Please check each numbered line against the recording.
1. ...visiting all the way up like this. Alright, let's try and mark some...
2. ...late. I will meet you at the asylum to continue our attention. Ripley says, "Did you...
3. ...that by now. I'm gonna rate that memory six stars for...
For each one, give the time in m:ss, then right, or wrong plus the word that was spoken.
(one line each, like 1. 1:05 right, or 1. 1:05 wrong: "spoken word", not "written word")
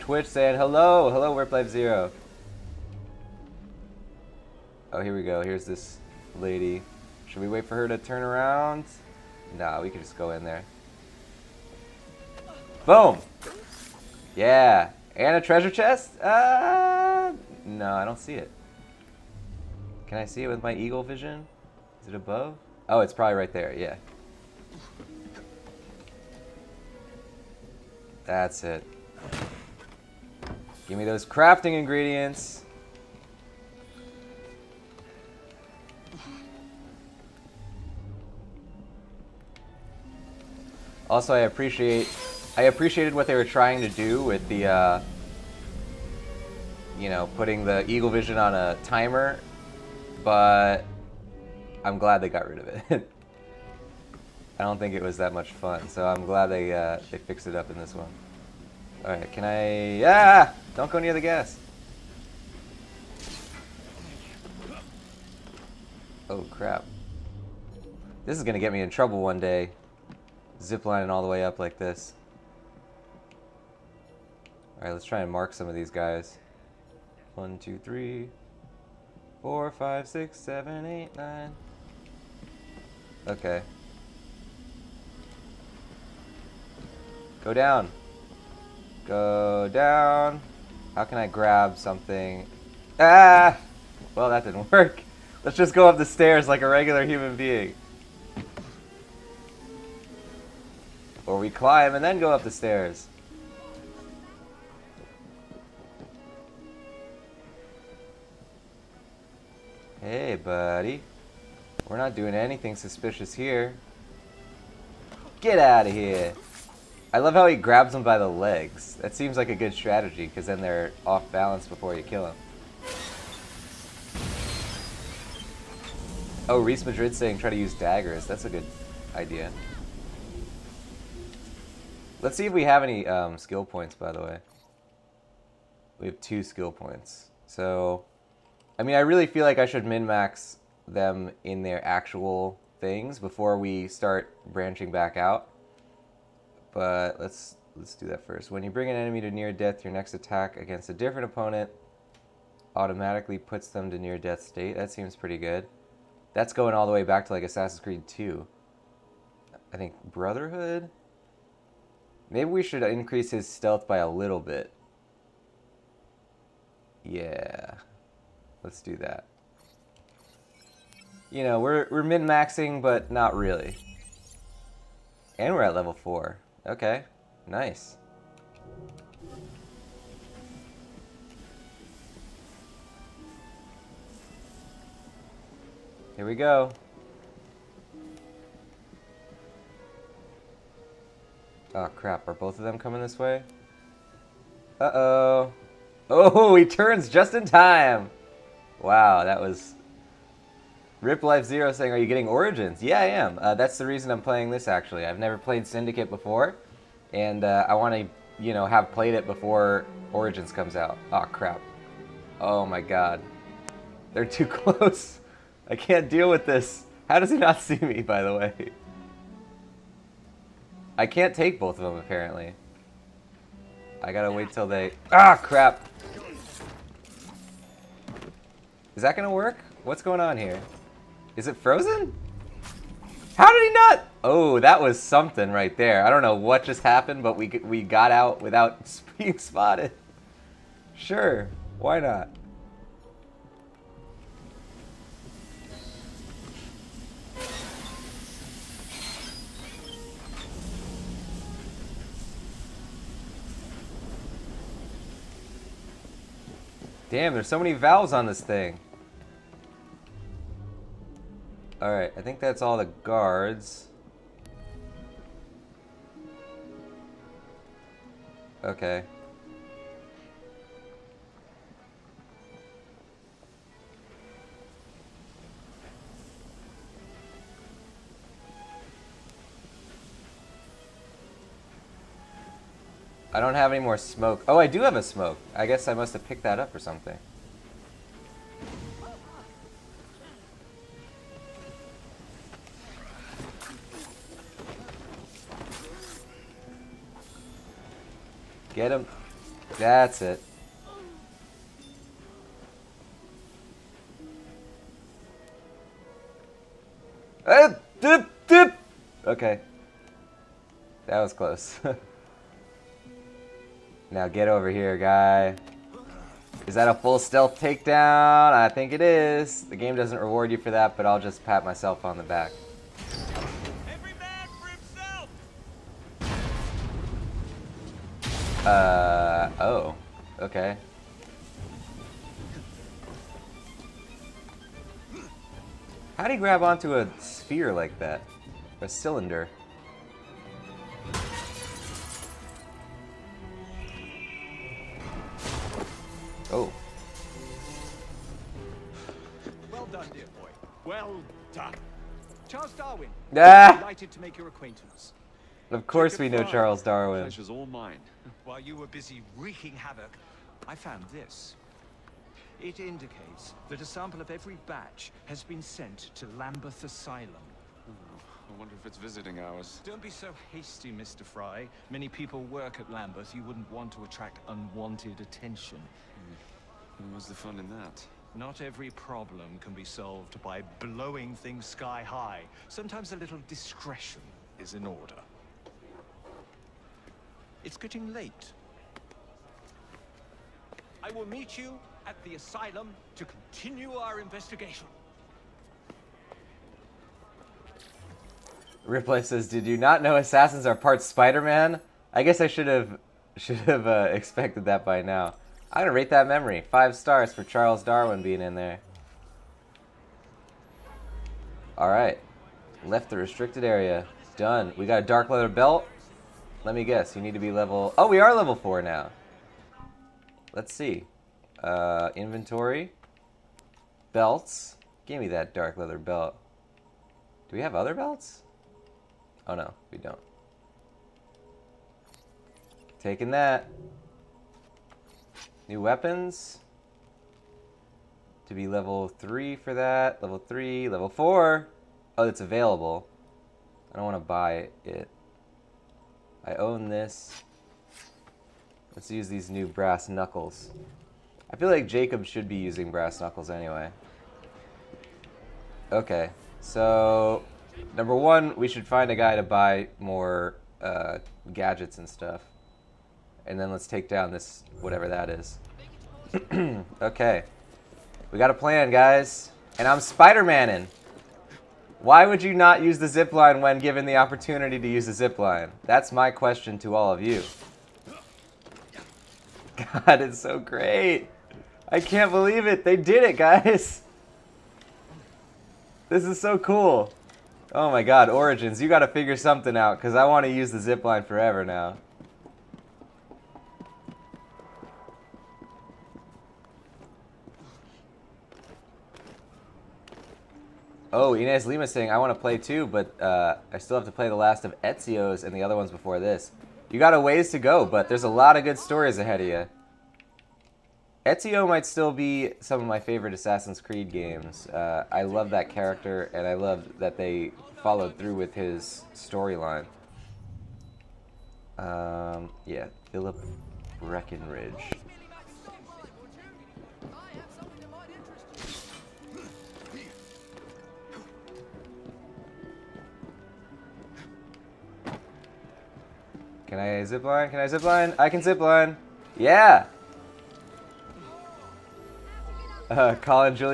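1. 1:10 wrong: "ziplining", not "visiting"
2. 6:28 wrong: "investigation", not "attention"
3. 6:44 wrong: "five", not "six".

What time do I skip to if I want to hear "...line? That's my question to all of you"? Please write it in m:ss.
7:55.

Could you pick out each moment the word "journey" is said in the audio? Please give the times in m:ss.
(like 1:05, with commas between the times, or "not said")
not said.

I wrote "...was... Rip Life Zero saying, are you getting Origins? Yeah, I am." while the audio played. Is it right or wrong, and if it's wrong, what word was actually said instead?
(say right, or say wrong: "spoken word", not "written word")
right.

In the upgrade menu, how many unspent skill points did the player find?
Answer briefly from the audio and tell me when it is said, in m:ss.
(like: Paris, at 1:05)
2, at 2:16.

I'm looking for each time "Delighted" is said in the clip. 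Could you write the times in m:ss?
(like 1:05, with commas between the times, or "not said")
5:53.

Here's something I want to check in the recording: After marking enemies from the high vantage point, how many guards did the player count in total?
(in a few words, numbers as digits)
9.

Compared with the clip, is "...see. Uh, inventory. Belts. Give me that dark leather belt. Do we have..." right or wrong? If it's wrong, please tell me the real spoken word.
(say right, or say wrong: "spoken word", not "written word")
right.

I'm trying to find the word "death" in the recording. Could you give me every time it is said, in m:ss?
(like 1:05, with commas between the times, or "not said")
2:29, 2:34.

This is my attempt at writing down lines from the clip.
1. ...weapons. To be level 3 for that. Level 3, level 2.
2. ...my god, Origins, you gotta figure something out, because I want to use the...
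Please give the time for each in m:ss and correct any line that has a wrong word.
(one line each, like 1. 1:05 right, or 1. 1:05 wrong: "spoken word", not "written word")
1. 7:15 wrong: "4", not "2"
2. 8:07 right.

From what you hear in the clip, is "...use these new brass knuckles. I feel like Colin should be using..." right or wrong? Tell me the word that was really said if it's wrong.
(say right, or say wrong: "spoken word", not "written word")
wrong: "Jacob", not "Colin".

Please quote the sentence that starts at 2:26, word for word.
But let's let's do that first.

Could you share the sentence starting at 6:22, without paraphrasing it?
Sometimes a little discretion is in order.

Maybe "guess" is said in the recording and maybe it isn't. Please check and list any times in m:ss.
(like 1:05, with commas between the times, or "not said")
4:45, 6:42, 6:56.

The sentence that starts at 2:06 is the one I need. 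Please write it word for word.
Oh, Reese Madrid saying try to use daggers.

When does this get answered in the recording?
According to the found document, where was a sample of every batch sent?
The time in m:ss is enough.
6:06.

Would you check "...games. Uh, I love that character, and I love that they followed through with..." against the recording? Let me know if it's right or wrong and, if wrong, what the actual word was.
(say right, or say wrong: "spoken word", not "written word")
right.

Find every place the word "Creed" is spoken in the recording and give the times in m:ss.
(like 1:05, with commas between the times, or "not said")
2:37, 8:33.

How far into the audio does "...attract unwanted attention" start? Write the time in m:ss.
6:14.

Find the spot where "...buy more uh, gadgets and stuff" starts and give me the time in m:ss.
7:39.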